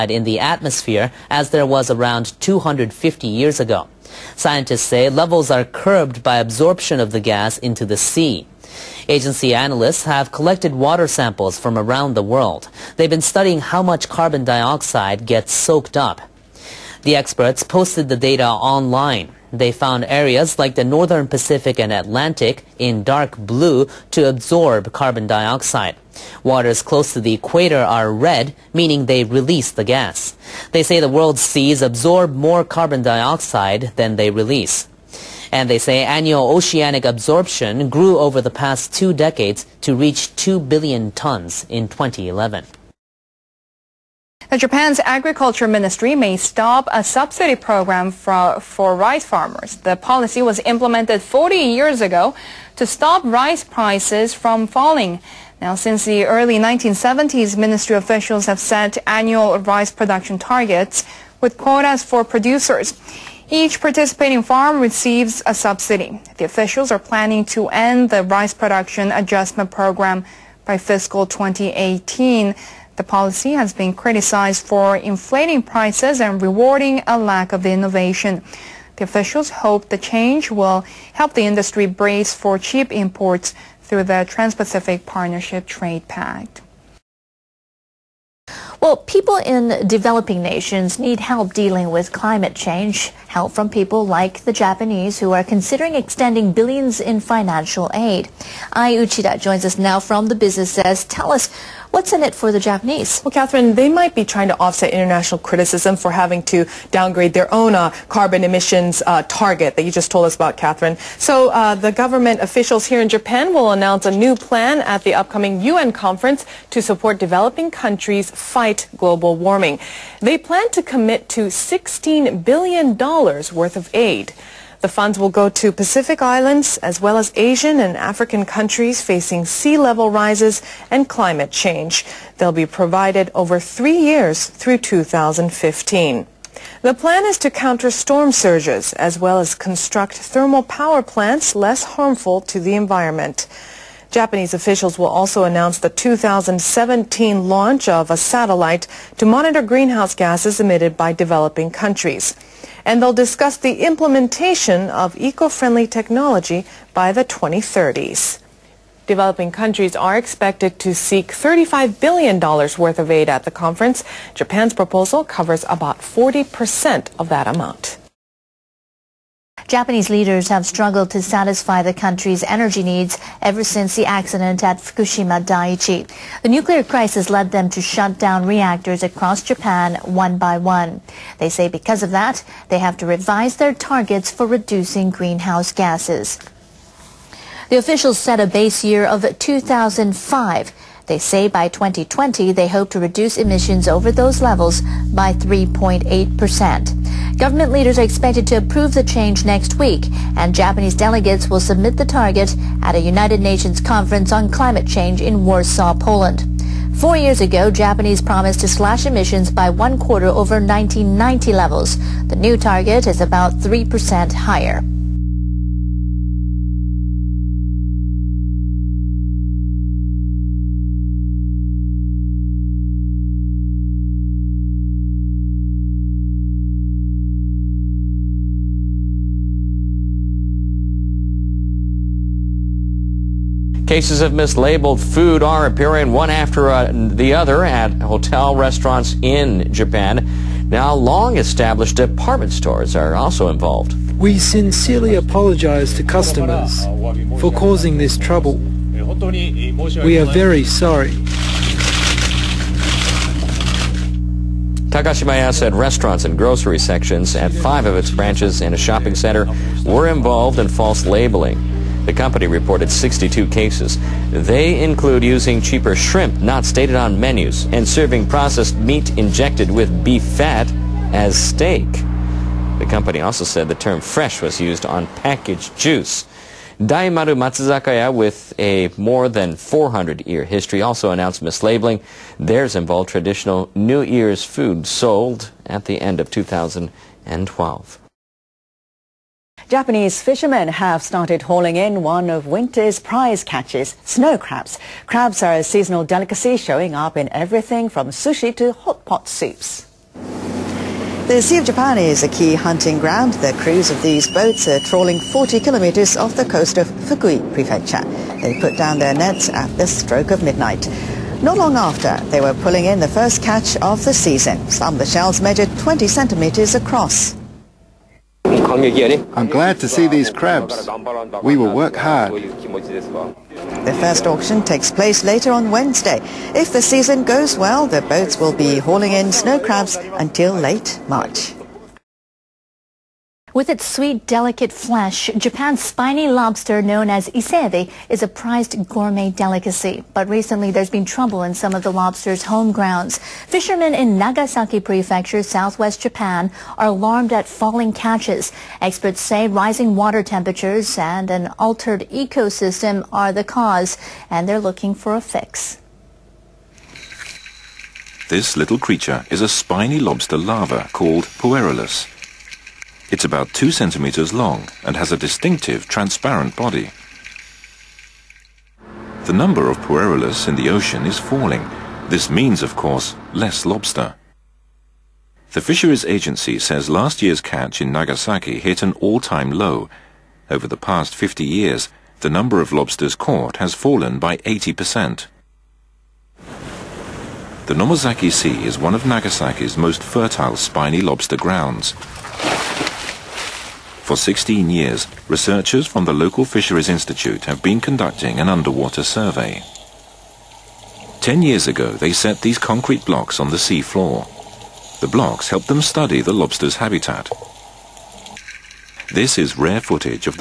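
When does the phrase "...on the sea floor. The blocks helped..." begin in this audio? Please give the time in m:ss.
6:43.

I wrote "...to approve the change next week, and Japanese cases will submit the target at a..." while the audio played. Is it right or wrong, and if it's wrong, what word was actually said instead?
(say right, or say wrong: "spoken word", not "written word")
wrong: "delegates", not "cases".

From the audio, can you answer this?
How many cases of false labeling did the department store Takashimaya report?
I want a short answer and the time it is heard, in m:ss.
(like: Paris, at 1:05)
62, at 4:22.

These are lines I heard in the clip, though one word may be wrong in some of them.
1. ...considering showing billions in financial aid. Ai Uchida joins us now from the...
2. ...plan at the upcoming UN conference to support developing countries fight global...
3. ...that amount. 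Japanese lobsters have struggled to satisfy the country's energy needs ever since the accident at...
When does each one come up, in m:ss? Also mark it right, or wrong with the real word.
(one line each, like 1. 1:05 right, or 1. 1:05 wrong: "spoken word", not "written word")
1. 1:35 wrong: "extending", not "showing"
2. 1:54 right
3. 2:47 wrong: "leaders", not "lobsters".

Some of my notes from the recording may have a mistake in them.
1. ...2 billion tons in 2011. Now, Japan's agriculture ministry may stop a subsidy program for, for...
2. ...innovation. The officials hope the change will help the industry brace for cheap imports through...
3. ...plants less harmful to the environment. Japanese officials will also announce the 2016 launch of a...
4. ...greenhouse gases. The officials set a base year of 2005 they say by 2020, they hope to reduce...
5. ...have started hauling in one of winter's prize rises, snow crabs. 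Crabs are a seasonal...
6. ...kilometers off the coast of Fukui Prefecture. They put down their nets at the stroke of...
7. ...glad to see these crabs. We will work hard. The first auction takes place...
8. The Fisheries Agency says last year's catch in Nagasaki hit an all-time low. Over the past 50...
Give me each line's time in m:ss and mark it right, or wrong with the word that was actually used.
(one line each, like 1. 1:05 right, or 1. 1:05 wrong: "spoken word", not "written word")
1. 0:40 right
2. 1:17 right
3. 2:21 wrong: "2017", not "2016"
4. 3:05 right
5. 4:50 wrong: "catches", not "rises"
6. 5:05 right
7. 5:19 right
8. 6:15 right.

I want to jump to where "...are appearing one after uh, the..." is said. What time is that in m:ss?
3:55.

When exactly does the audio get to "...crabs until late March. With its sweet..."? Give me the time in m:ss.
5:29.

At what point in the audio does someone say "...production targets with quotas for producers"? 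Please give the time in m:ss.
0:59.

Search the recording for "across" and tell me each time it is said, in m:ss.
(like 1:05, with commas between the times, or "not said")
2:59, 5:16.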